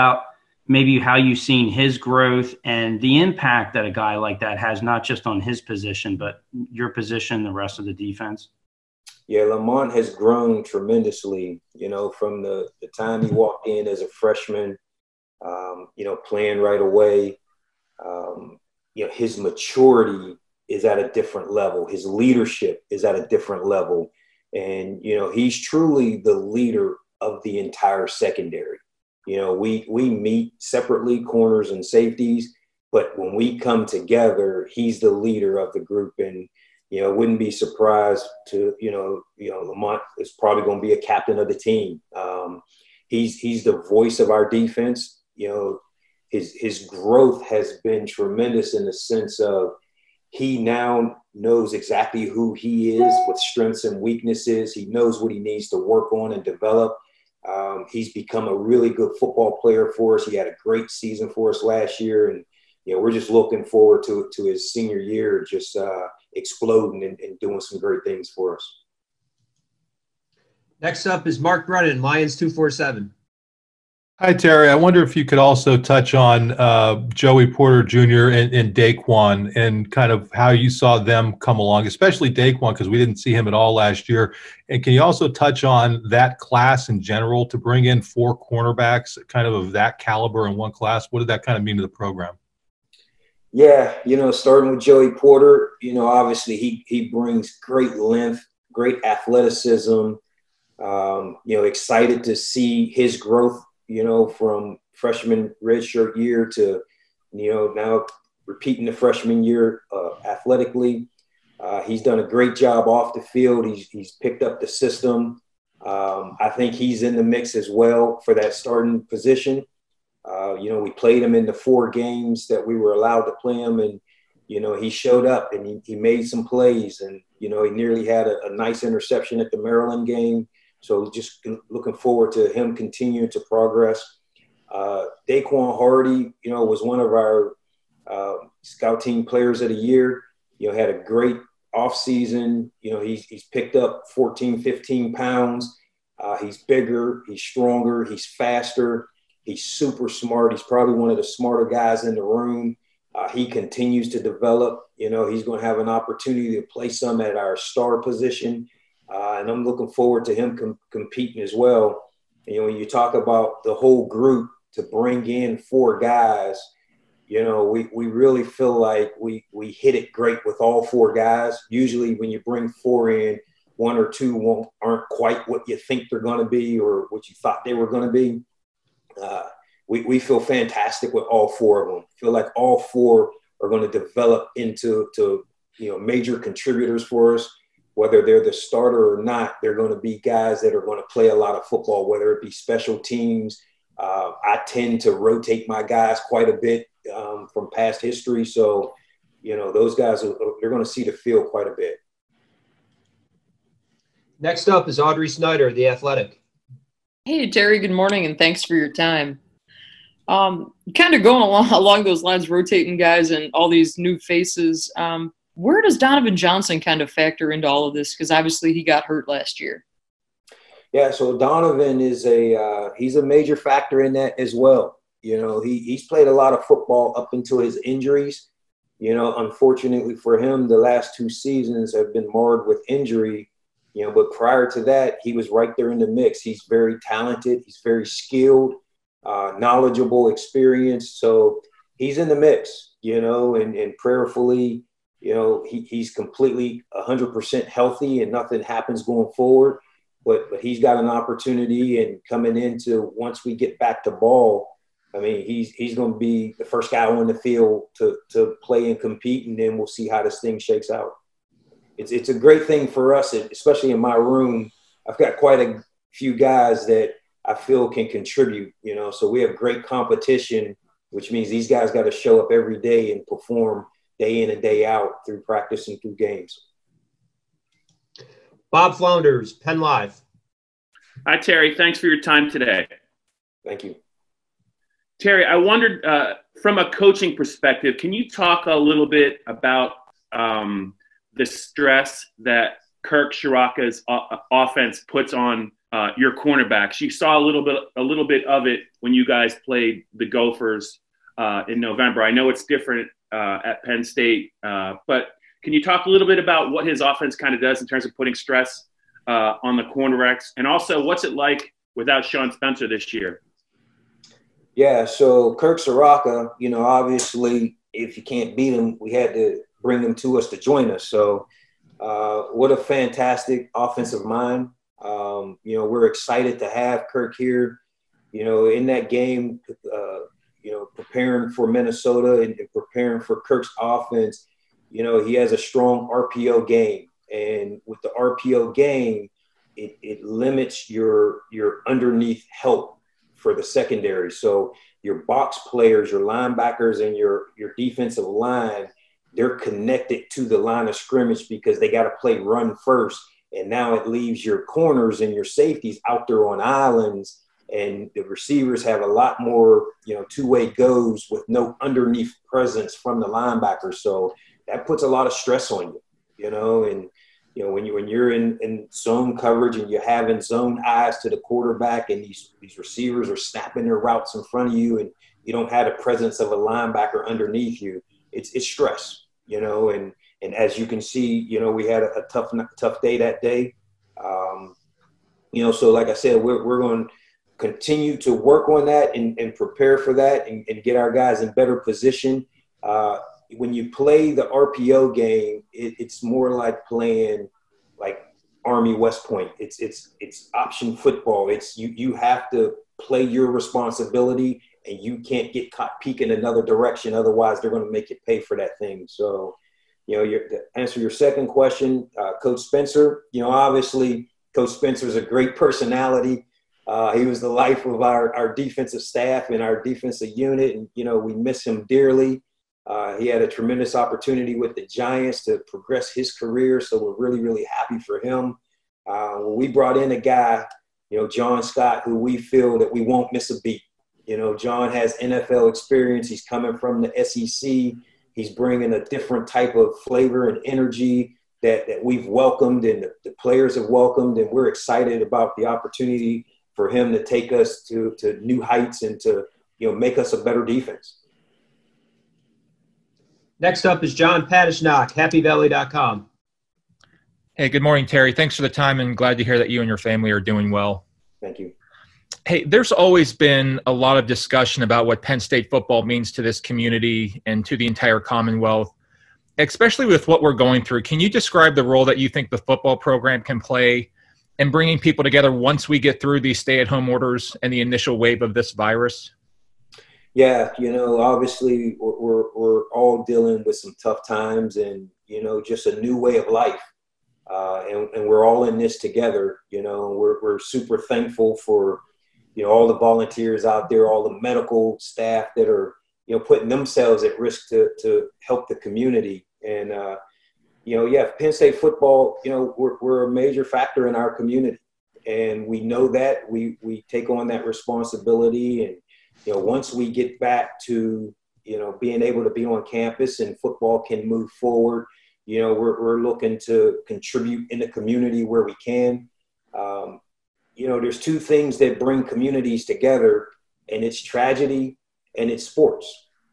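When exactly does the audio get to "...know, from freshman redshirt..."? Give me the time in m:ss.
1:44.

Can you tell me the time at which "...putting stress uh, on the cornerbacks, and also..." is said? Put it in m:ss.
5:08.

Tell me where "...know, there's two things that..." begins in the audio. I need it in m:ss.
8:40.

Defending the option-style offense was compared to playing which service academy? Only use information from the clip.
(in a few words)
Army West Point.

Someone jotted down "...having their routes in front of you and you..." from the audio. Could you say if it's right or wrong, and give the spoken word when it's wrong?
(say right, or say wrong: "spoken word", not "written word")
wrong: "snapping", not "having".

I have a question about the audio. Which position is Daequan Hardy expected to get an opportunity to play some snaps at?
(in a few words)
star.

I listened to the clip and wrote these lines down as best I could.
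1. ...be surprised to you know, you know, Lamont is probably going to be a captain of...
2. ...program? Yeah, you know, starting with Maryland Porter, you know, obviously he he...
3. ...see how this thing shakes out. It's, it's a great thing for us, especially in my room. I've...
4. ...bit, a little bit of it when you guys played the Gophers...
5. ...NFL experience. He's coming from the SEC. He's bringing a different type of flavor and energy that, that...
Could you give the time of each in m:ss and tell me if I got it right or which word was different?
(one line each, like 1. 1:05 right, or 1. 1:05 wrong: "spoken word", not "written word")
1. 0:37 right
2. 1:31 wrong: "Joey", not "Maryland"
3. 4:19 right
4. 4:57 right
5. 7:15 right.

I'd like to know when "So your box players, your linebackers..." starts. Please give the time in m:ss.
5:44.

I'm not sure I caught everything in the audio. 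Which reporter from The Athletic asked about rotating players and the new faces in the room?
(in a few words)
Audrey Snyder.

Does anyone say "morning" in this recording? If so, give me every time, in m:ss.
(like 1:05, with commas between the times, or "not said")
3:27, 7:37.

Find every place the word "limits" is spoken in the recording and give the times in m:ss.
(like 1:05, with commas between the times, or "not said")
5:40.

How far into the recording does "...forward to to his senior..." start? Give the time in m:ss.
1:03.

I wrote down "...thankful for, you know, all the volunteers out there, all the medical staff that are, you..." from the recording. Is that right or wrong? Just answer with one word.
right.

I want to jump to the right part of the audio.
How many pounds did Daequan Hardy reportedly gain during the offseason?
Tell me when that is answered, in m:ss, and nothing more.
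2:24.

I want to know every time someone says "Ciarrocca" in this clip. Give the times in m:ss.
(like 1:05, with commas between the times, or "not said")
4:53, 5:15.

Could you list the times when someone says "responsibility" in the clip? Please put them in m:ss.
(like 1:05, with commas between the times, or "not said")
6:43, 8:27.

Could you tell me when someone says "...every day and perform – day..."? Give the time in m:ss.
4:32.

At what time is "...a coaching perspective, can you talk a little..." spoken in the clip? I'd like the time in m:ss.
4:46.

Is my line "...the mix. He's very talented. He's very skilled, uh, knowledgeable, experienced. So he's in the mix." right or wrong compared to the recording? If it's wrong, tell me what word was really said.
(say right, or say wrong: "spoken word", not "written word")
right.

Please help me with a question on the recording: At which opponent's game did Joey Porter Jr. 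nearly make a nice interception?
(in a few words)
Maryland.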